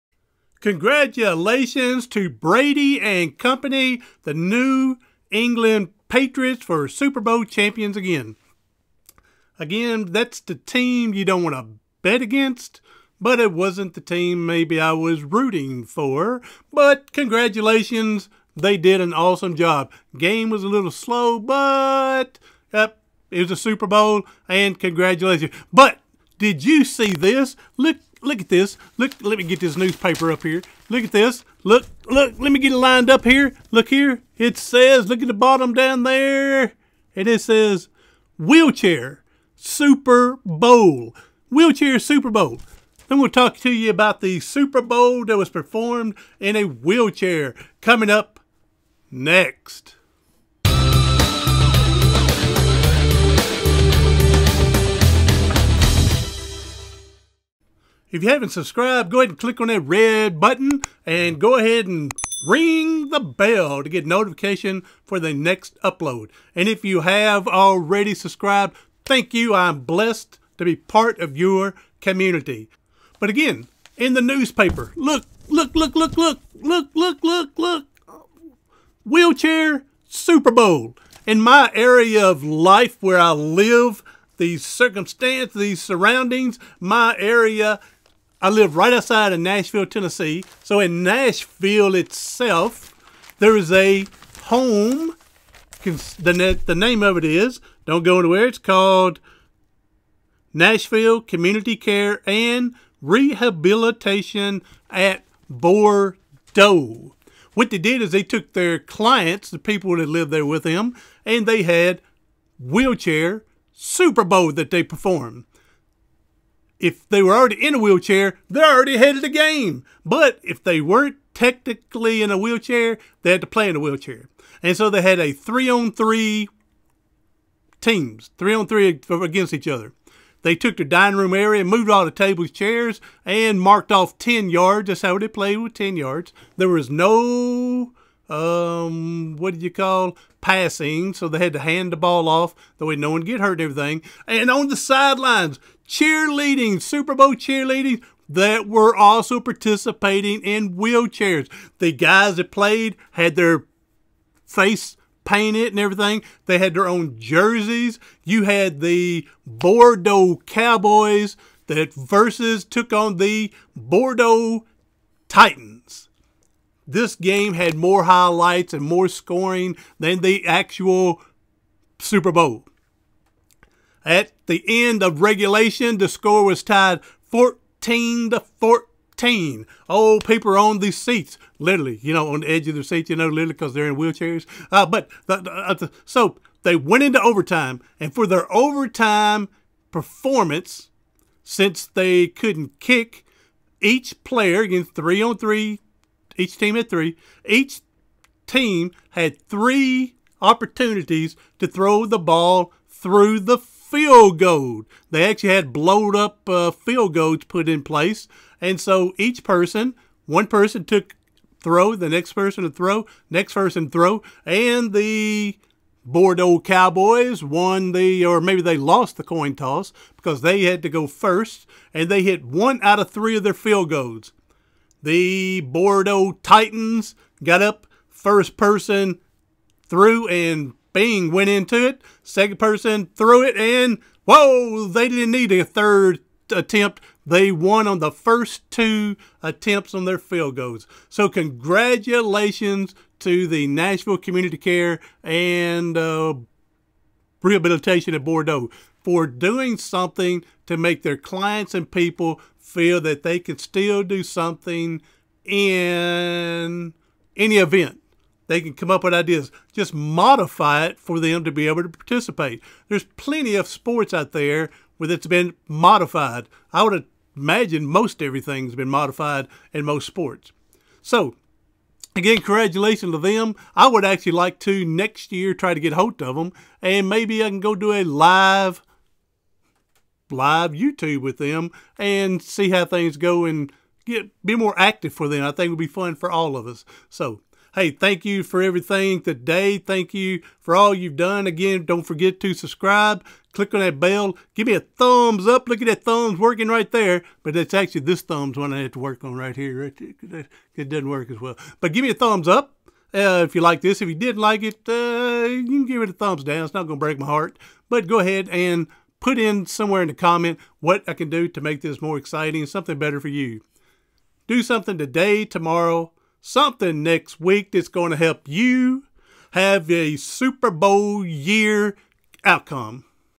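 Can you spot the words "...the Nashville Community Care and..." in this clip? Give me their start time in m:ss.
4:03.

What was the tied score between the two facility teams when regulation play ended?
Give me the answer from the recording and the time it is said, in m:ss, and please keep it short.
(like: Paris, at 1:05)
14 to 14, at 2:57.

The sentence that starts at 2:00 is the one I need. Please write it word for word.
But if they weren't technically in a wheelchair, they had to play in a wheelchair.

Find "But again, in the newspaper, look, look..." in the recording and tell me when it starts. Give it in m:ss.
1:13.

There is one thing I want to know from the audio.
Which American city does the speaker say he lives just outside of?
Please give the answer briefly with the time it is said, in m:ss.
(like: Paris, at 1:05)
Nashville, Tennessee, at 1:29.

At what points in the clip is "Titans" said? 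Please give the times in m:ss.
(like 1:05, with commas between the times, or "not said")
2:45, 3:46.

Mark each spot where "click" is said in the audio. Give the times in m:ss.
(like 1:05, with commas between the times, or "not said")
0:59, 4:53.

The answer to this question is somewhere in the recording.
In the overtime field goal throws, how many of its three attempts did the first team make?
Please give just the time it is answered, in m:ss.
3:42.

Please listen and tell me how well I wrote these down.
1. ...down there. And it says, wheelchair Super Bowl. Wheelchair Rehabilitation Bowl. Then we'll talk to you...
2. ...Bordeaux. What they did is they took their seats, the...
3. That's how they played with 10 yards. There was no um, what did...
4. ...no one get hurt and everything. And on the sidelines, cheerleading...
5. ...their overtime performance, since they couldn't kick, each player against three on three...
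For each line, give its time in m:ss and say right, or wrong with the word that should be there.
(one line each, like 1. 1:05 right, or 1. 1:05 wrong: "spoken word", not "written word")
1. 0:35 wrong: "Super", not "Rehabilitation"
2. 1:45 wrong: "clients", not "seats"
3. 2:14 right
4. 2:22 right
5. 3:08 right.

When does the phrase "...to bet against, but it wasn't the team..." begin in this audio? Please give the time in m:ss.
0:11.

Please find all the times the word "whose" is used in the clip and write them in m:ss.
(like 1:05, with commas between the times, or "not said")
not said.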